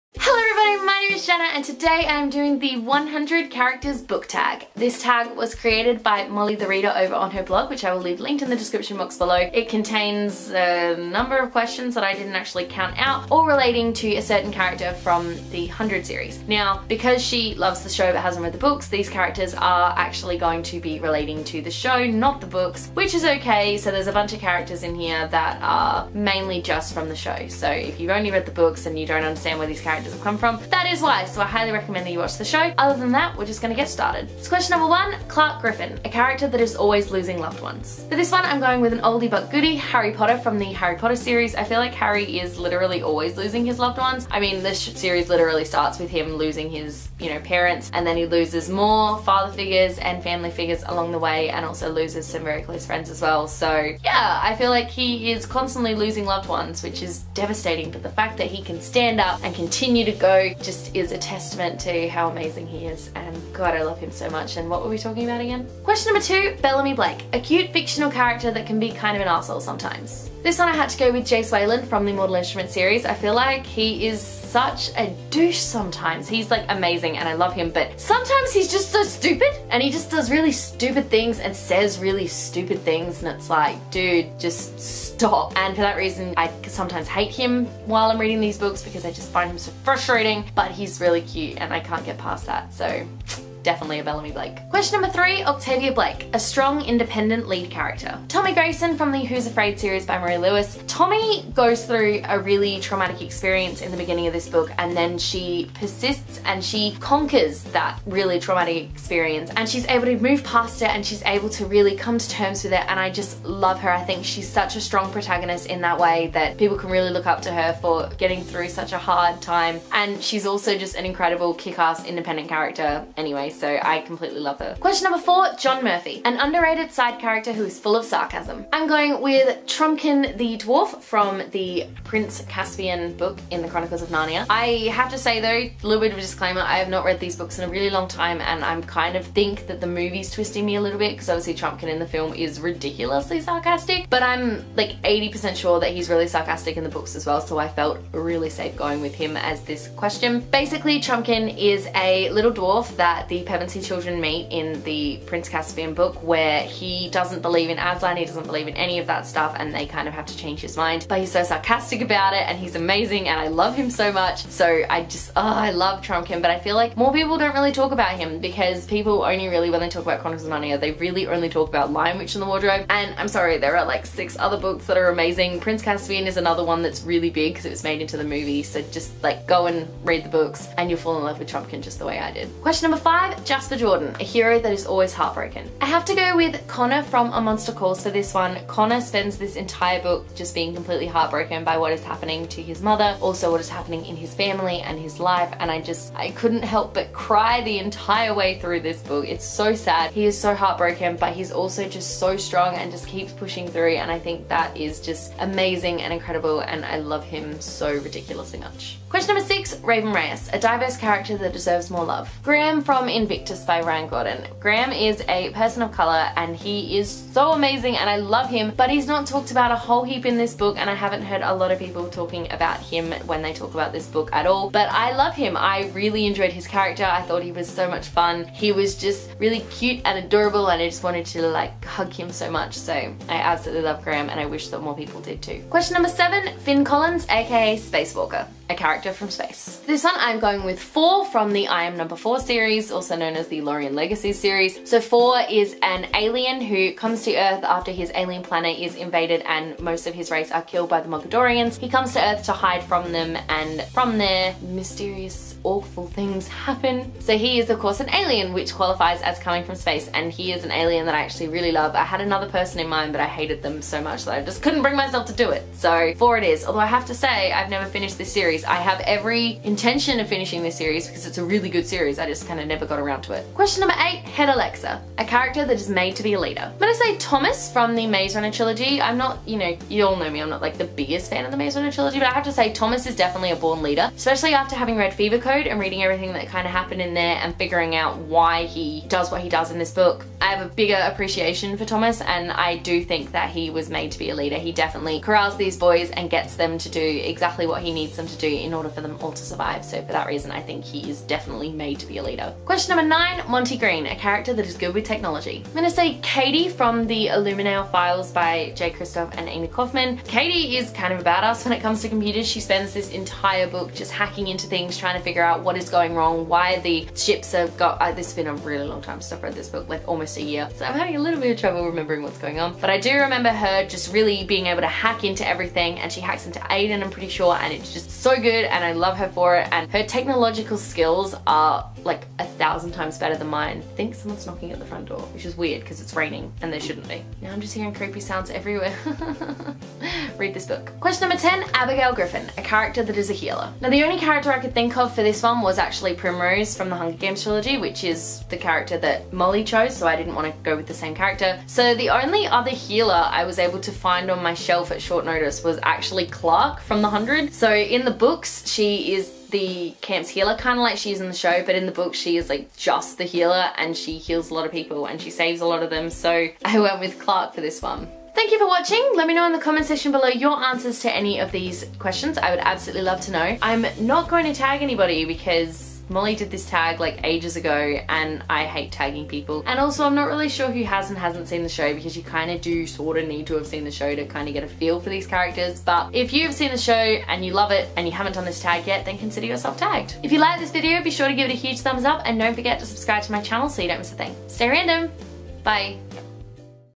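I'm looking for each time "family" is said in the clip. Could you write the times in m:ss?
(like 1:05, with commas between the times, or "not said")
0:50, 3:14.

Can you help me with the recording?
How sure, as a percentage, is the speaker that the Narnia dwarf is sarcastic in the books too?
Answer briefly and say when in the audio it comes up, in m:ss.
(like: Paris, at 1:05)
80%, at 2:25.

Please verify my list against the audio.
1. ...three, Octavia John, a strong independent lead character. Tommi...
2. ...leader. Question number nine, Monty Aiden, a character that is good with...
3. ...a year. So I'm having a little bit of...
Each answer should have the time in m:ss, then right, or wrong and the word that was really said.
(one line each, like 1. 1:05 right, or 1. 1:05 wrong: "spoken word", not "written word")
1. 1:35 wrong: "Blake", not "John"
2. 5:02 wrong: "Green", not "Aiden"
3. 5:20 right.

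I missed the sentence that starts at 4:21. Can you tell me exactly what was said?
I had another person in mind but I hated them so much that I just couldn't bring myself to do it.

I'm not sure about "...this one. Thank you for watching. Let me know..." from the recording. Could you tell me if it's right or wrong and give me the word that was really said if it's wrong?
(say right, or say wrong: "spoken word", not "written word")
right.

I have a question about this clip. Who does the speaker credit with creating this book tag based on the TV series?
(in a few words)
Mollie the Reader.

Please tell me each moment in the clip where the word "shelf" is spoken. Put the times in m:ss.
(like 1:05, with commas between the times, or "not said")
5:54.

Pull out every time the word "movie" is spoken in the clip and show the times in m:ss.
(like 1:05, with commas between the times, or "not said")
2:19, 2:58.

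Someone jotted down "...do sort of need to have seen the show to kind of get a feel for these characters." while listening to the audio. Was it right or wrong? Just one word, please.
right.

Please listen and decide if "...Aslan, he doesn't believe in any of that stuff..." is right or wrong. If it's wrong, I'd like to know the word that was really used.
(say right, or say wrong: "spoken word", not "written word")
right.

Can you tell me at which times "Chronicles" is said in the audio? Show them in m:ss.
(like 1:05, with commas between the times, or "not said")
2:13, 2:50.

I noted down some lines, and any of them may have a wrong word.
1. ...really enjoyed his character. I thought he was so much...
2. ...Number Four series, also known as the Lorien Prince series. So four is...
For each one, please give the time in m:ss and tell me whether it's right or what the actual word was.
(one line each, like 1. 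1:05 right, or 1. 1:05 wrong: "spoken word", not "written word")
1. 3:45 right
2. 4:01 wrong: "Legacy", not "Prince".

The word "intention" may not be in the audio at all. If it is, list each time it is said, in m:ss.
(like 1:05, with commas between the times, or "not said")
4:29.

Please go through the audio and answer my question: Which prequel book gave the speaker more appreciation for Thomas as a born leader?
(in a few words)
Fever Code.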